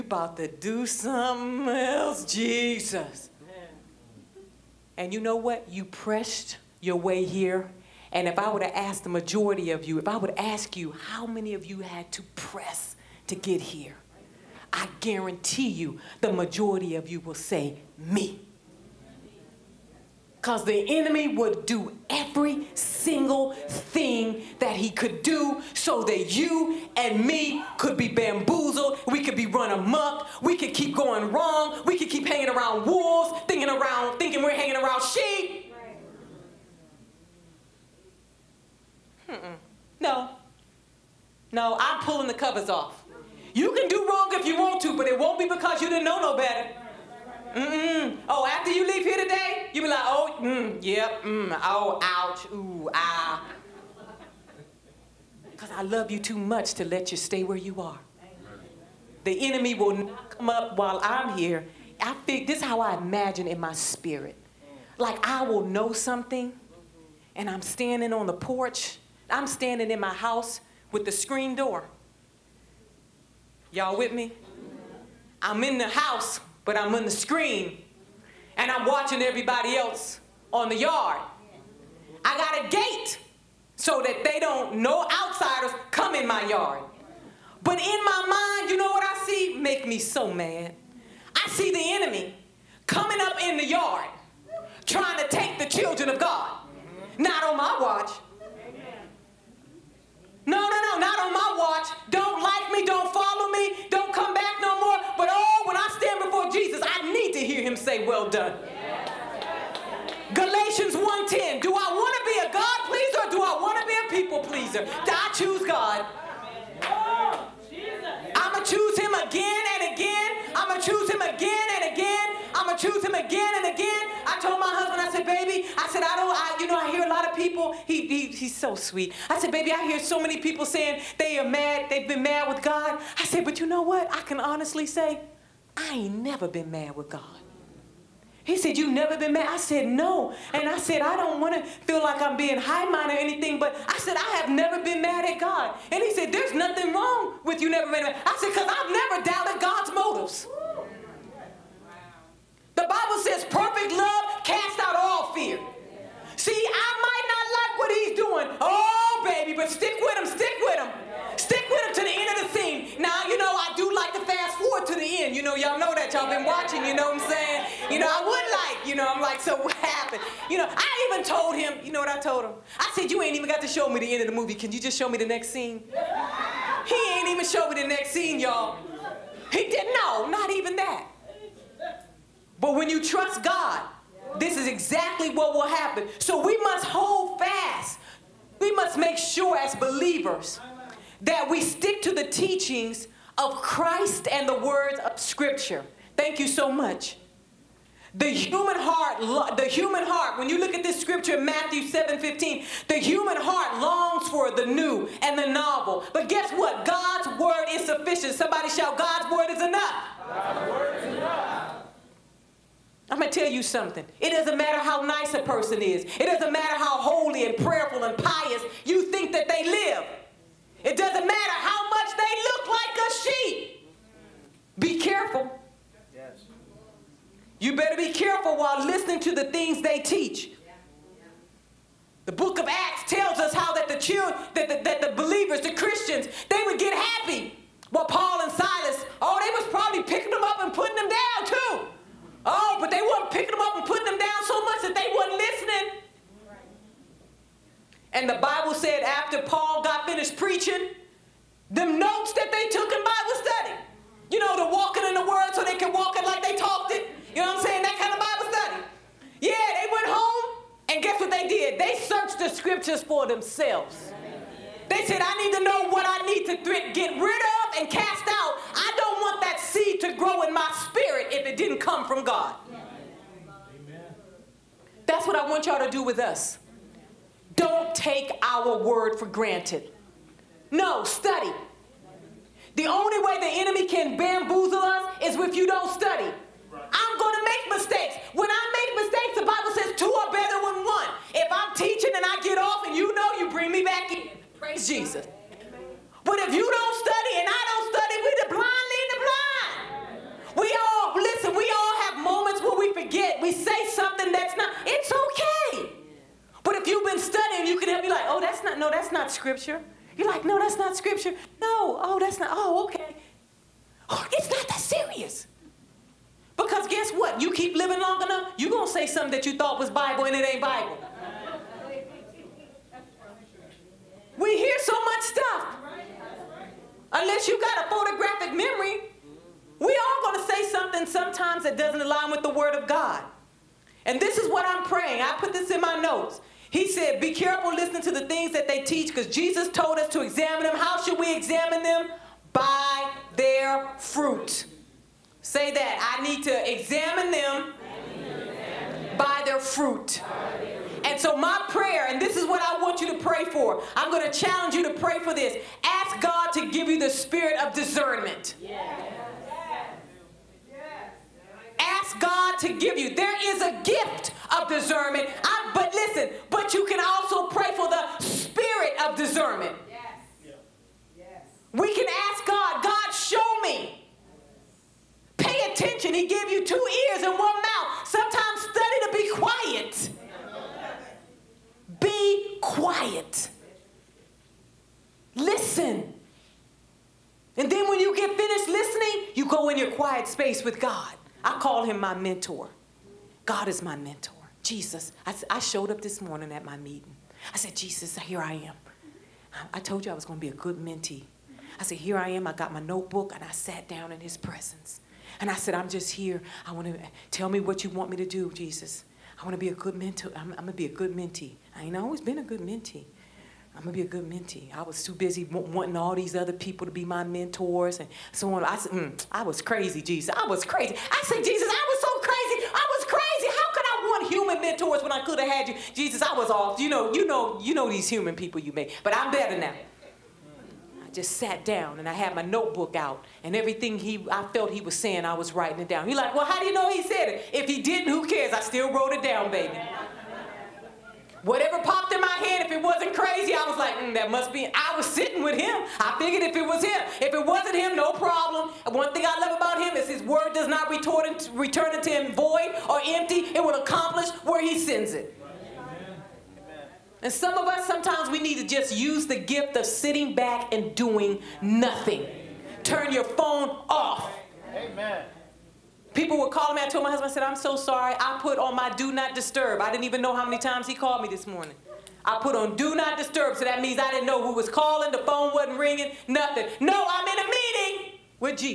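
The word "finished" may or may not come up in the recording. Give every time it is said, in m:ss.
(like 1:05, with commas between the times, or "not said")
4:10, 6:28.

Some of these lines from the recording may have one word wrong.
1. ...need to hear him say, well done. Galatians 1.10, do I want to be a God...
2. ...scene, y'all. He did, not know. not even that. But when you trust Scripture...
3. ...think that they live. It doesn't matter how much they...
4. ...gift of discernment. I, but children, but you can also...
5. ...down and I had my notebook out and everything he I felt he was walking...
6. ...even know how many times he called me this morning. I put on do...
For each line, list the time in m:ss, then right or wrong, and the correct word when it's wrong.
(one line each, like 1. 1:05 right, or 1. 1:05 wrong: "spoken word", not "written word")
1. 1:47 right
2. 2:58 wrong: "God", not "Scripture"
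3. 3:39 right
4. 6:03 wrong: "listen", not "children"
5. 7:11 wrong: "saying", not "walking"
6. 7:50 right.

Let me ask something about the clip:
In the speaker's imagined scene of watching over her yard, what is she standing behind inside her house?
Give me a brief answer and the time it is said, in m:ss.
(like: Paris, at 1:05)
The screen door, at 1:11.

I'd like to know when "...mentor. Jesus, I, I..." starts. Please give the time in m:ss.
6:33.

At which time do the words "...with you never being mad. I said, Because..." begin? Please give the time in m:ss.
2:27.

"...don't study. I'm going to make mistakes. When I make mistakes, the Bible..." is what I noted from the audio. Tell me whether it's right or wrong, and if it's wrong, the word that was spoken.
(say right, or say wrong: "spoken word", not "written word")
right.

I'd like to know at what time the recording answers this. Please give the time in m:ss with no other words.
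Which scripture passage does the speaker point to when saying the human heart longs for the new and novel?
3:21.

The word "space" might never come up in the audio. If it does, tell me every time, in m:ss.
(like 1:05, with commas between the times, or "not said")
6:30.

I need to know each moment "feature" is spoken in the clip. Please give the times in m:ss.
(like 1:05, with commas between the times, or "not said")
not said.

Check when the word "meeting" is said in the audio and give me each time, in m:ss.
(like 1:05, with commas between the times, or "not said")
6:36, 7:57.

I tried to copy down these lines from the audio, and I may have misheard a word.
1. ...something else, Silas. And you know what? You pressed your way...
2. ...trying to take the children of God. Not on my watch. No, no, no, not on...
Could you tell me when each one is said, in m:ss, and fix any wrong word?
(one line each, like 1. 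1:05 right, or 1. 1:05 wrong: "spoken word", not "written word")
1. 0:00 wrong: "Jesus", not "Silas"
2. 1:34 right.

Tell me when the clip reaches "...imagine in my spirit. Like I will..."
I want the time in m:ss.
1:02.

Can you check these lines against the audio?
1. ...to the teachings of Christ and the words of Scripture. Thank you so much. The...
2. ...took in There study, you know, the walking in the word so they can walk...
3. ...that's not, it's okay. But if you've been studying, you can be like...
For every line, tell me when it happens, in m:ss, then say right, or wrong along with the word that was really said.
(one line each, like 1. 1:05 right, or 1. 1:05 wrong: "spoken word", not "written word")
1. 3:12 right
2. 4:12 wrong: "Bible", not "There"
3. 5:04 right.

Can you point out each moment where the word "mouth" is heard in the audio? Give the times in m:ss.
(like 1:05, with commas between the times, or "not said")
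6:17.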